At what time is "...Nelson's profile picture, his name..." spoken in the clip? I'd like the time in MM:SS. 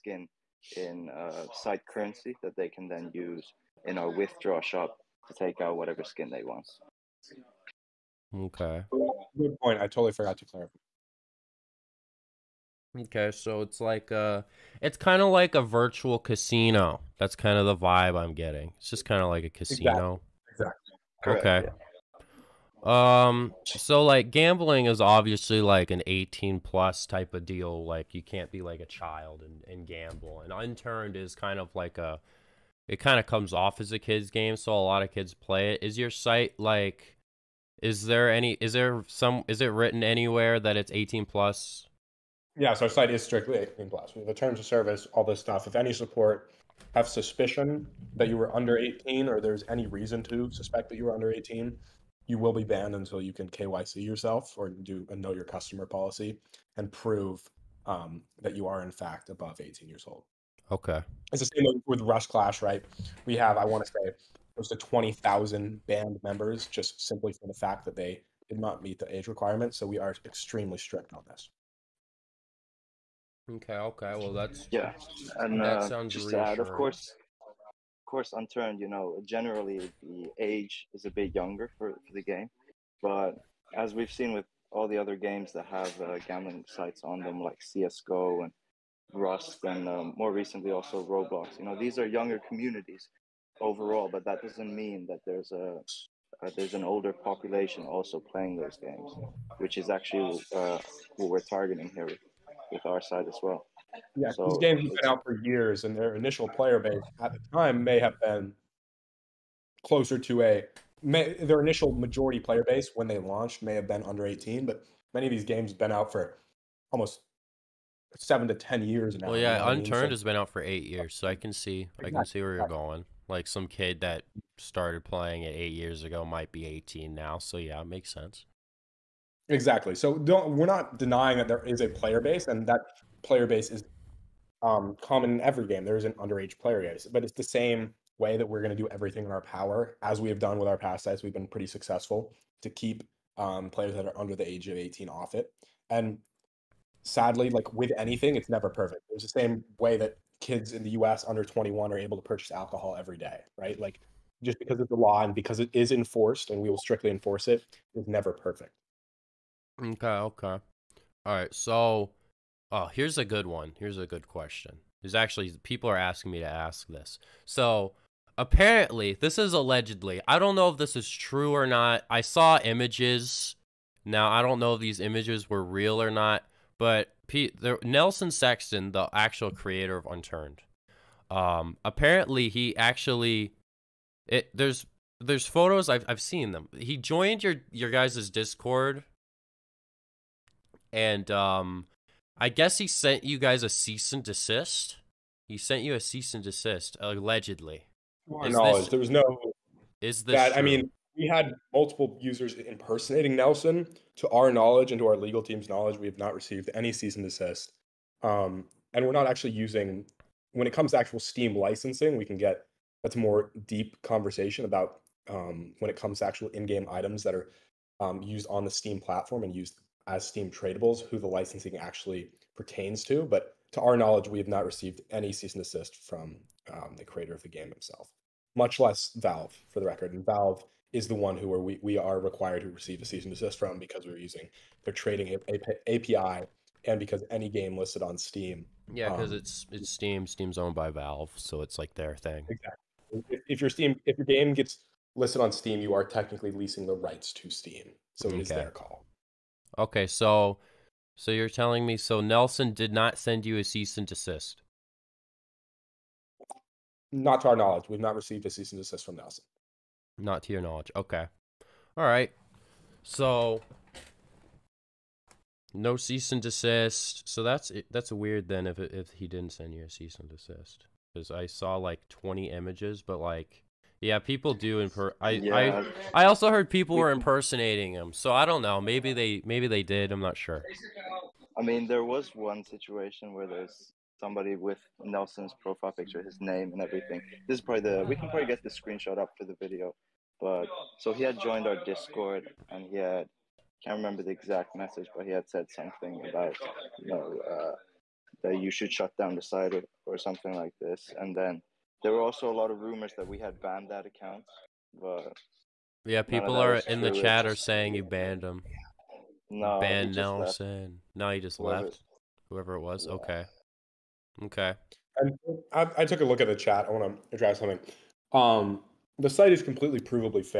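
04:45.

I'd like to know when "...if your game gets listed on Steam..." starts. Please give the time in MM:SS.
04:04.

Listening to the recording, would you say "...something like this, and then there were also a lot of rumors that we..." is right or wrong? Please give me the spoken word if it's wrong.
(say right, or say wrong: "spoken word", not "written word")
right.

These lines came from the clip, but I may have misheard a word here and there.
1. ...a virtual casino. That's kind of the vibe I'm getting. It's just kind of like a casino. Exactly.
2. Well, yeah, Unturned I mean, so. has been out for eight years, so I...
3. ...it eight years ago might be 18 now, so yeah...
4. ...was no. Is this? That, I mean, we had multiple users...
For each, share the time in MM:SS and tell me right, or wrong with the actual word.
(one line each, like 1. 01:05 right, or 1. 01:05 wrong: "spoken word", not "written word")
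1. 00:15 right
2. 01:59 right
3. 02:05 right
4. 03:18 right.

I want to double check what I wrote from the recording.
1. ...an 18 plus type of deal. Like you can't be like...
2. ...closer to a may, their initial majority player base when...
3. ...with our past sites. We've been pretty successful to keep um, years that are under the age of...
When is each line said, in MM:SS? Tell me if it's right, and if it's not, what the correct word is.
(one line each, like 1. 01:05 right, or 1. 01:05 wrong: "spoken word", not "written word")
1. 00:25 right
2. 01:49 right
3. 02:20 wrong: "players", not "years".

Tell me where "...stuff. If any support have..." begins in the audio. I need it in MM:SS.
00:45.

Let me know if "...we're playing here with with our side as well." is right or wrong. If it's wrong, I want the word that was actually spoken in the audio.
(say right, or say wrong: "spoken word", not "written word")
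wrong: "targeting", not "playing".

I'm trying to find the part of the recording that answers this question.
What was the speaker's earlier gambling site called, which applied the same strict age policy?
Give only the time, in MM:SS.
01:02.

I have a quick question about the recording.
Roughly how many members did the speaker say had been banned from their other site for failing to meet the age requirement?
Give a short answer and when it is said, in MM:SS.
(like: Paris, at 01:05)
20,000, at 01:04.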